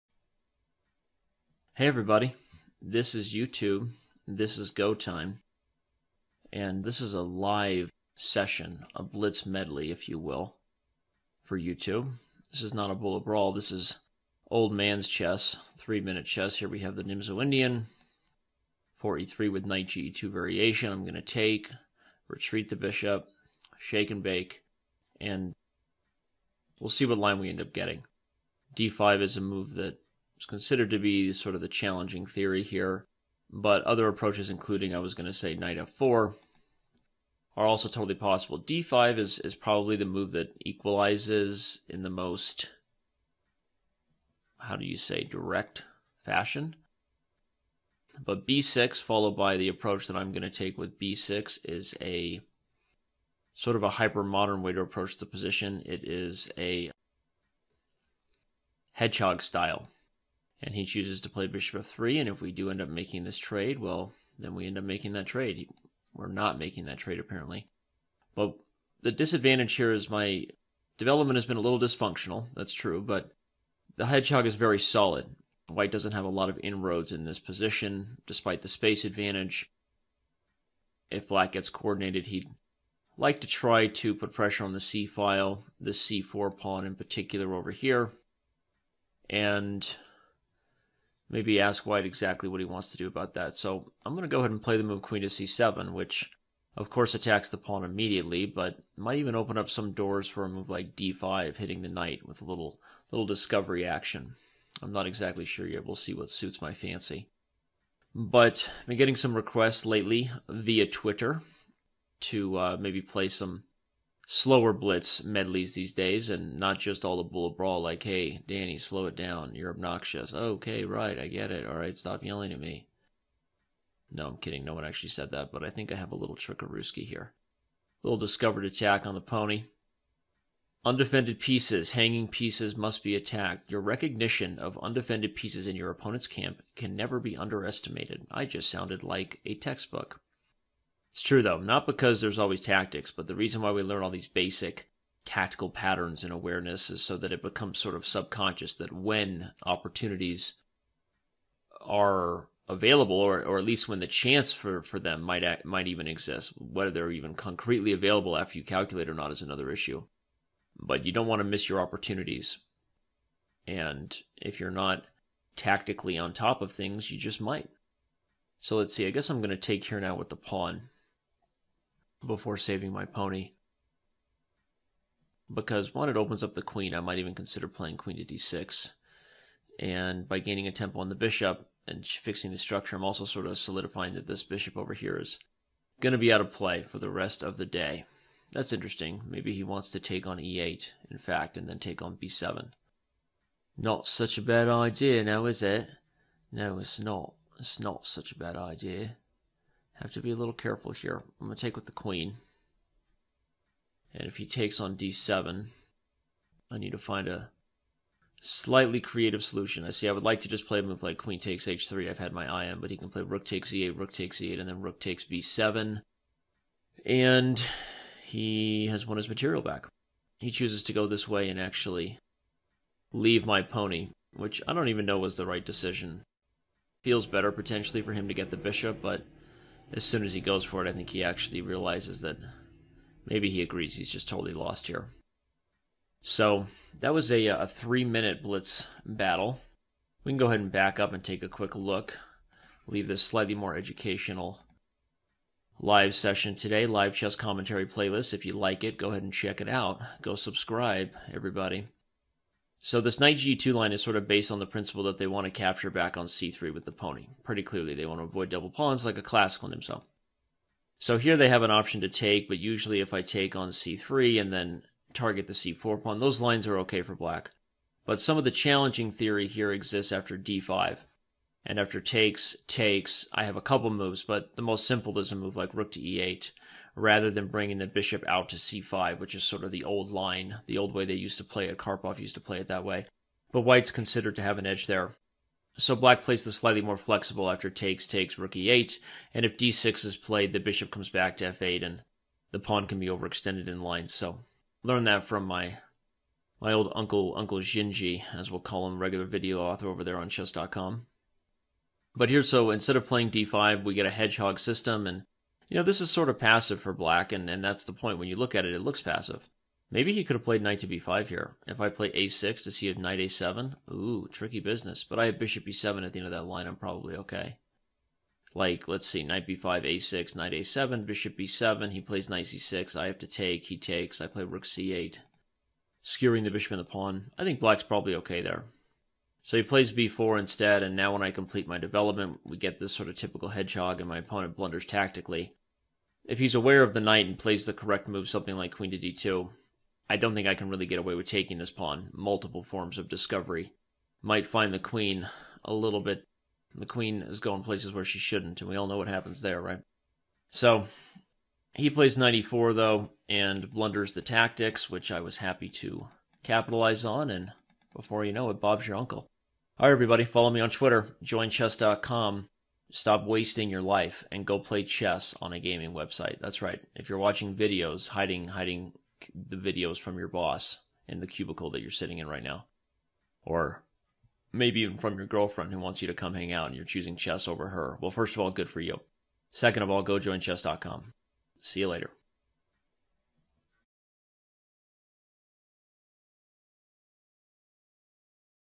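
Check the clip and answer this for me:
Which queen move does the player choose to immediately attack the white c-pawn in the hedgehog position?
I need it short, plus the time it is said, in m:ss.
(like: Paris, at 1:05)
Queen to c7, at 1:35.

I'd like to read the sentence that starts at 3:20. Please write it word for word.
Have to be a little careful here.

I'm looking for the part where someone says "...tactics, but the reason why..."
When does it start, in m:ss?
2:22.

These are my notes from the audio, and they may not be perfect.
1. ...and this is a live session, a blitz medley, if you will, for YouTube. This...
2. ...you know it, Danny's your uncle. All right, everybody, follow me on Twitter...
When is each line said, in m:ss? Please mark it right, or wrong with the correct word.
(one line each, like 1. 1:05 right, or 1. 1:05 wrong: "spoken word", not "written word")
1. 0:06 right
2. 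5:58 wrong: "Bob", not "Danny".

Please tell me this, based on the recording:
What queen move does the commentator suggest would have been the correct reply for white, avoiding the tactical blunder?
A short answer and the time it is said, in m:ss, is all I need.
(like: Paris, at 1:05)
Queen to d2, at 5:38.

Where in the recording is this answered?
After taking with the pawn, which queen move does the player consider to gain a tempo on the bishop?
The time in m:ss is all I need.
2:57.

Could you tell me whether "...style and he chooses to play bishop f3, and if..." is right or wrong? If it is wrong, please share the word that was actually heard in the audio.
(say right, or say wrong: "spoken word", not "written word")
right.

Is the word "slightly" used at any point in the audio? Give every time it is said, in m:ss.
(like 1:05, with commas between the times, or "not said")
3:28, 4:03, 4:46.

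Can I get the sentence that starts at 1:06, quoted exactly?
We're not making that trade, apparently.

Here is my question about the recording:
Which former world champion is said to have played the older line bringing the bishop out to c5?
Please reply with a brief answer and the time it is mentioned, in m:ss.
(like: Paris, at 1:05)
Karpov, at 4:41.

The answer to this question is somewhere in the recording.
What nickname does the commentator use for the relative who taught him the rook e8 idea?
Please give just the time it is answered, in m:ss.
4:57.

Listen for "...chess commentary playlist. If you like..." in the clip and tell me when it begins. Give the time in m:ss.
4:07.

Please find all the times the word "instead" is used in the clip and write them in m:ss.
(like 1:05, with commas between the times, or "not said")
5:02, 5:30.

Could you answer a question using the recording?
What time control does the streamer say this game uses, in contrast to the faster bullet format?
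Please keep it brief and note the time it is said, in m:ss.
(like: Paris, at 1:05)
3 minutes, at 0:15.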